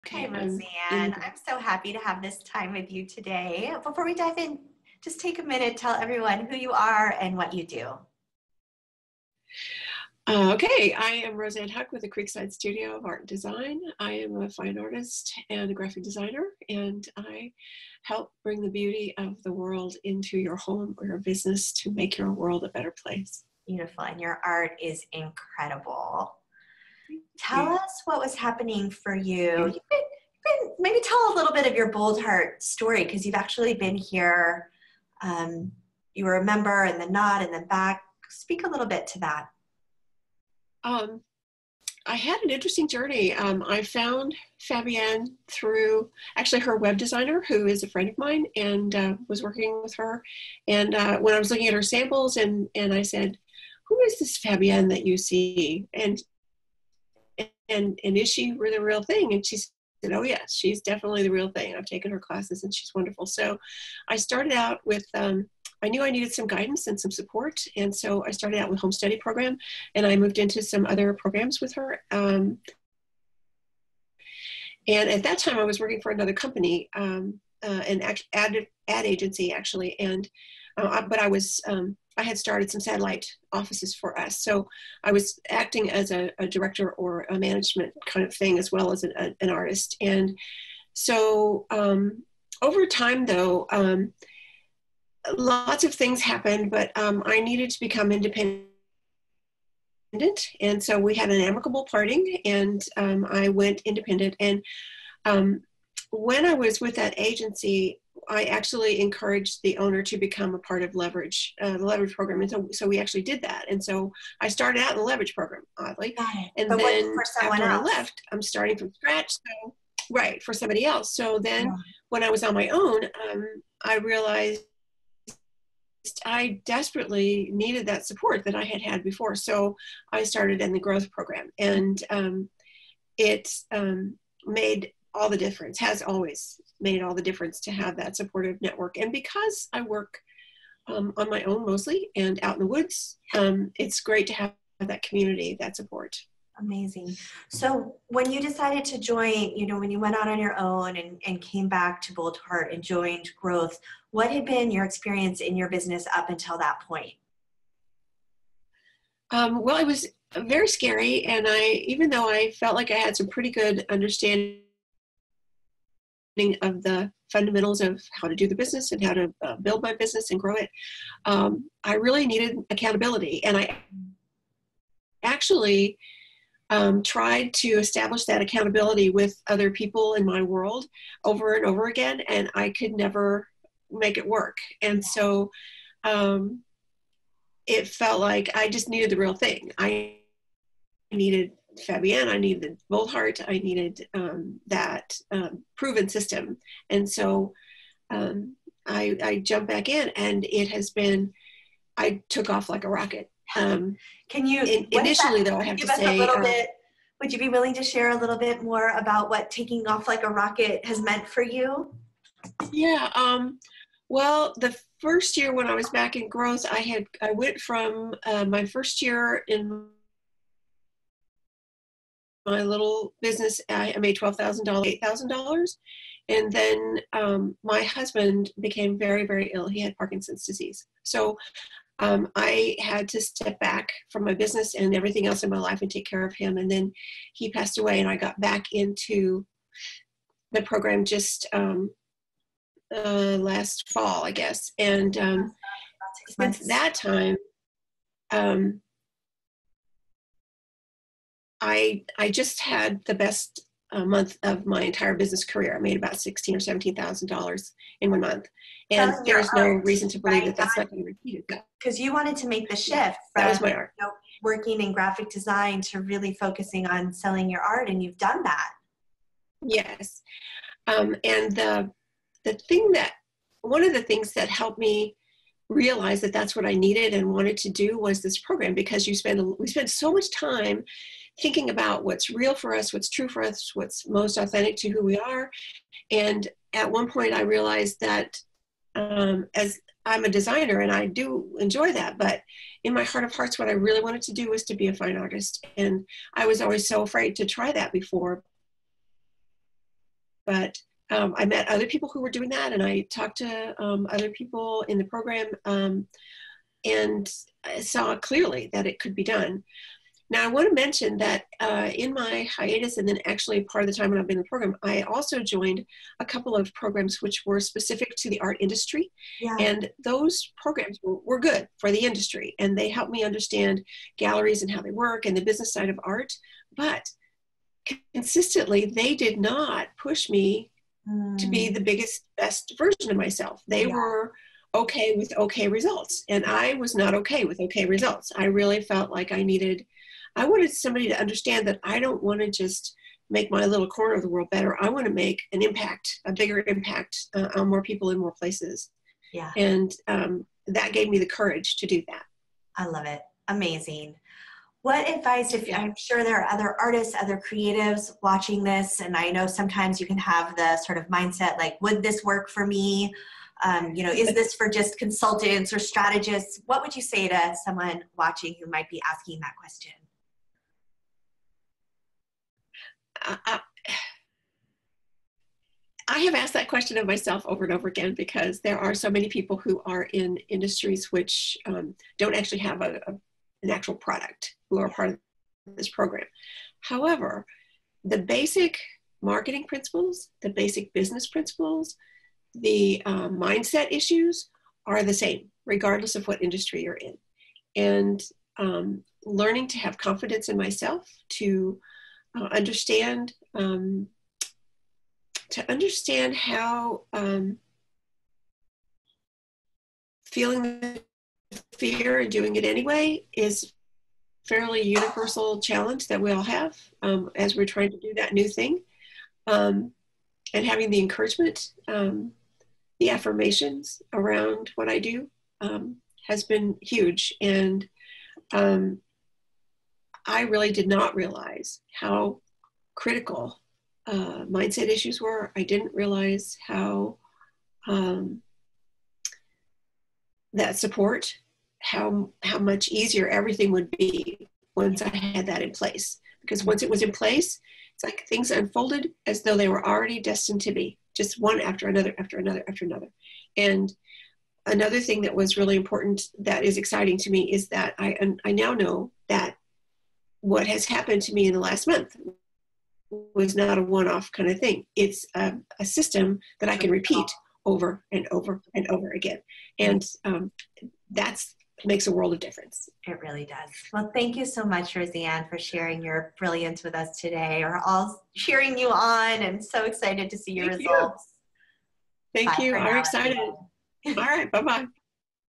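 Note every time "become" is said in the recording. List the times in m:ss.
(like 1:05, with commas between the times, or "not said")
1:37, 1:50.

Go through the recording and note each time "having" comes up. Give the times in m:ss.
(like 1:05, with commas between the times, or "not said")
7:00.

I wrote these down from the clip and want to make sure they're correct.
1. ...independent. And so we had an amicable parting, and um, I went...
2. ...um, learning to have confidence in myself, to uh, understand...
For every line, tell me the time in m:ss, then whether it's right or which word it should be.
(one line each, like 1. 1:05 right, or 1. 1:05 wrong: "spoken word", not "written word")
1. 1:38 right
2. 6:38 right.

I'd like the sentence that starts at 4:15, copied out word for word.
I made about sixteen or seventeen thousand dollars in one month, and there's no art.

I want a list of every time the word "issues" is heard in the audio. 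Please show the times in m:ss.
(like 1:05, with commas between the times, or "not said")
6:33, 7:14.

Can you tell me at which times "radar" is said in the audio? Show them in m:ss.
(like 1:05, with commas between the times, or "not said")
not said.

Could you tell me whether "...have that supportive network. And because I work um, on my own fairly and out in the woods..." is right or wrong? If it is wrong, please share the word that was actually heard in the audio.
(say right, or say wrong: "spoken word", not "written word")
wrong: "mostly", not "fairly".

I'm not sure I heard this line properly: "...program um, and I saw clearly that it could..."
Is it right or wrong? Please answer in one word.
right.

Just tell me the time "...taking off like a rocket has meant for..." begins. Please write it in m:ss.
3:29.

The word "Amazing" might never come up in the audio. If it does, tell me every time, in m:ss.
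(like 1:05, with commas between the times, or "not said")
2:26, 5:53.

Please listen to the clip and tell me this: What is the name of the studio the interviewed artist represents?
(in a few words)
Creekside Studio of Art and Design.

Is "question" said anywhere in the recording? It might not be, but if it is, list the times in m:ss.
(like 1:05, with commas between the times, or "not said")
6:09, 6:16.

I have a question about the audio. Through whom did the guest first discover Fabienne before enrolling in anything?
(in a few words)
Her web designer.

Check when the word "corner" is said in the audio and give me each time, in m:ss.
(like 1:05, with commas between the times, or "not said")
5:43.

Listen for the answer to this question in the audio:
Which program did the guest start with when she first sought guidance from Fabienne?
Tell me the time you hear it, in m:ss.
1:08.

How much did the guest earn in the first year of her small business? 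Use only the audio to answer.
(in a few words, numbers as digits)
$8,000.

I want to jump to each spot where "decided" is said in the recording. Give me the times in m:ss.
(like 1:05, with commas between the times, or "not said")
2:28.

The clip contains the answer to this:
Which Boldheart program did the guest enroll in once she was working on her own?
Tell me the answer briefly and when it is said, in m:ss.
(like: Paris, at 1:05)
Growth program, at 2:10.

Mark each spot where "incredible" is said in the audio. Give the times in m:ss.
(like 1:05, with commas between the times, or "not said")
0:25.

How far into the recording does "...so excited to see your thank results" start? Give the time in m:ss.
7:59.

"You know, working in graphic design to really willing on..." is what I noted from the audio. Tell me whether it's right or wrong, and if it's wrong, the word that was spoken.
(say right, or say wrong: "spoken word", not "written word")
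wrong: "focusing", not "willing".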